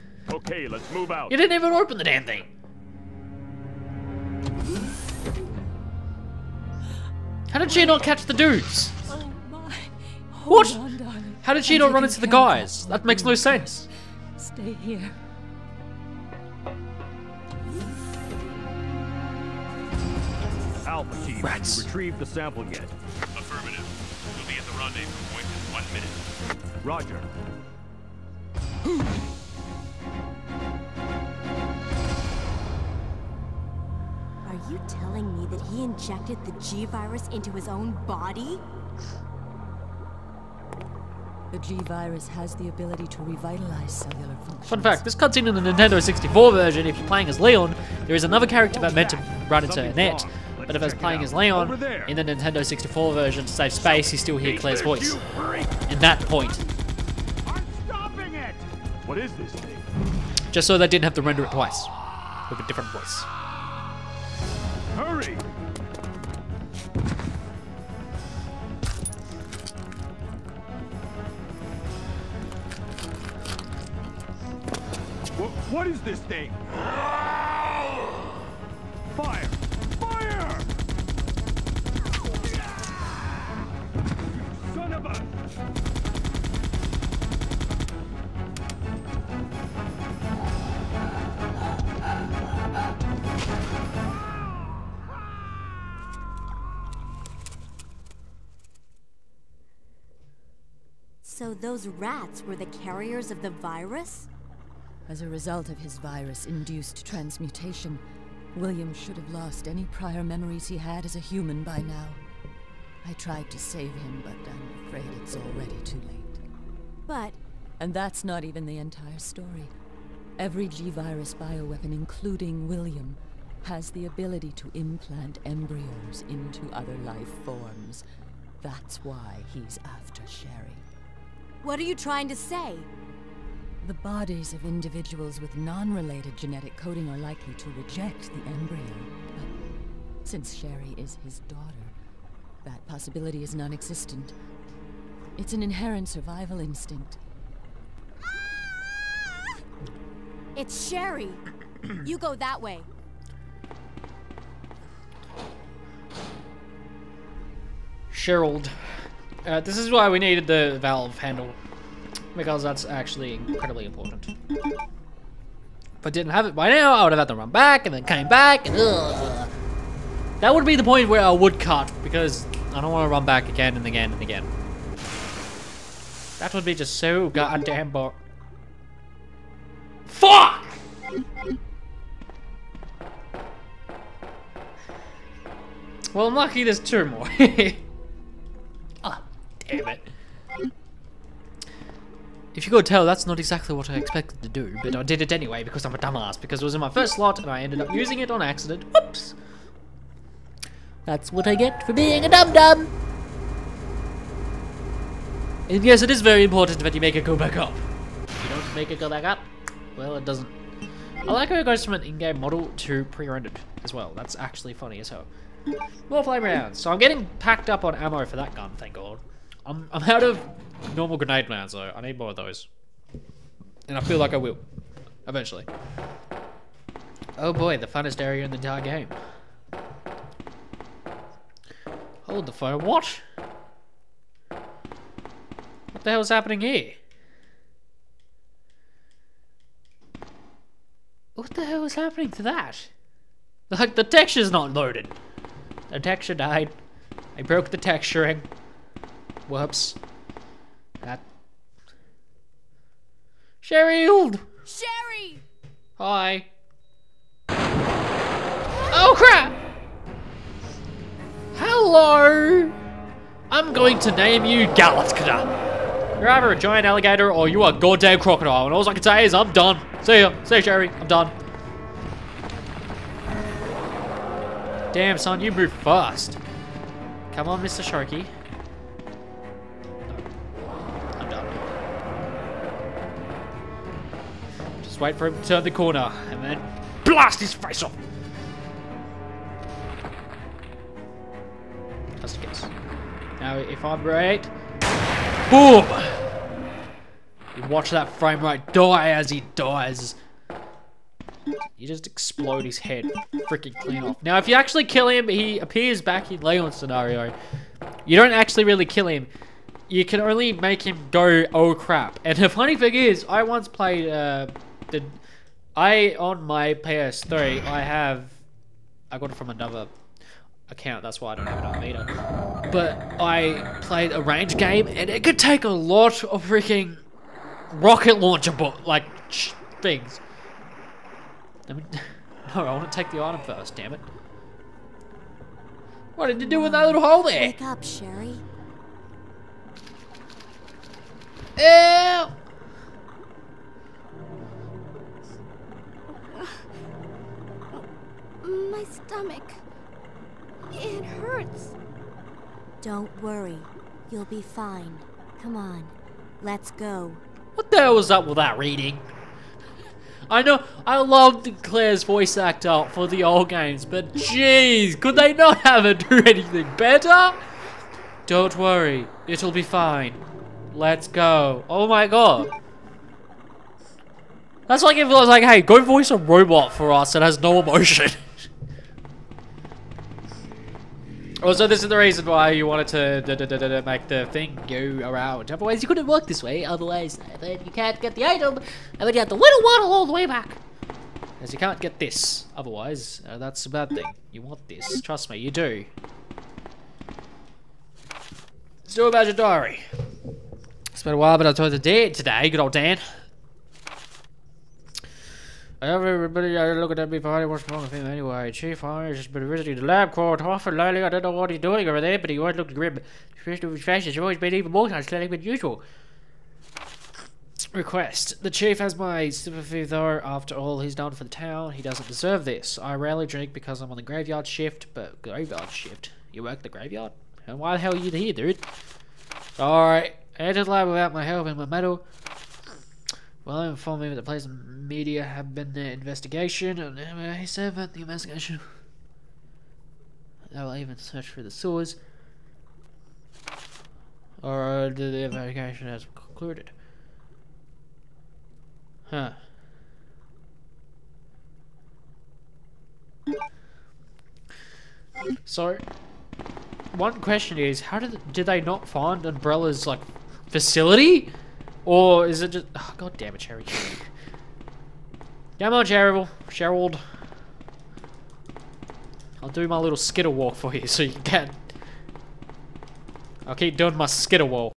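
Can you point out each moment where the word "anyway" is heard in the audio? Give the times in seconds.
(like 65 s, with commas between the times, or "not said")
195 s, 408 s.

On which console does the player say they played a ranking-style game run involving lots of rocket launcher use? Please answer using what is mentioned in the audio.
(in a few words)
PS3.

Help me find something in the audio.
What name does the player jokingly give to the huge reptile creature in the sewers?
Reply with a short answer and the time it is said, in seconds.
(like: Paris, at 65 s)
Galatka, at 264 s.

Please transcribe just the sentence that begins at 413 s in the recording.
His face has always been even more unsettling than usual.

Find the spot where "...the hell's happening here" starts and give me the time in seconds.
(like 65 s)
236 s.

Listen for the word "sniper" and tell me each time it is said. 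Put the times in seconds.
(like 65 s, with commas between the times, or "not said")
not said.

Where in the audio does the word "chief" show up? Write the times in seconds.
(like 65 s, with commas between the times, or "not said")
408 s, 418 s.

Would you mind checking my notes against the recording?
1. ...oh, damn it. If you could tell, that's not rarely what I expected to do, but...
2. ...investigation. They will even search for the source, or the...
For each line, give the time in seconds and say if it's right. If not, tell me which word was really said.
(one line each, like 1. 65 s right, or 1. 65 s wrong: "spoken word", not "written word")
1. 189 s wrong: "exactly", not "rarely"
2. 438 s right.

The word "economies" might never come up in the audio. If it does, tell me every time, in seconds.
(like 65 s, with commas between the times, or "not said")
not said.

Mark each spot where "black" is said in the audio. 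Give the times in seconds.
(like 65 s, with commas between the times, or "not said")
not said.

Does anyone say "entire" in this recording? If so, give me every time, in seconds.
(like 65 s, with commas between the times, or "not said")
118 s, 228 s.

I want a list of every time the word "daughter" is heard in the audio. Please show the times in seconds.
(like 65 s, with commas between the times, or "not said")
141 s.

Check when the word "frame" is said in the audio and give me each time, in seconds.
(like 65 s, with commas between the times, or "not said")
298 s.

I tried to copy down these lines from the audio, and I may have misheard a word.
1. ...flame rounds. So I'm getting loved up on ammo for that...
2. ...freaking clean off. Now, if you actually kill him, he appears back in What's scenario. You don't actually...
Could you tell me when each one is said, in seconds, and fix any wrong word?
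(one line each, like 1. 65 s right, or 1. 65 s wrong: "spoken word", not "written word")
1. 216 s wrong: "packed", not "loved"
2. 303 s wrong: "Leon", not "What".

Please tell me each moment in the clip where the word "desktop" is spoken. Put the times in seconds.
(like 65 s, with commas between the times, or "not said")
not said.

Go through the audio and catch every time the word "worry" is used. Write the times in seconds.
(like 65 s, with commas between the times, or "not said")
353 s, 368 s.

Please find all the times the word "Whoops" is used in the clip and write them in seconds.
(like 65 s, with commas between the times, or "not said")
198 s, 249 s.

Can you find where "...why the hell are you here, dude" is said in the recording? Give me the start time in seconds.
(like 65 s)
427 s.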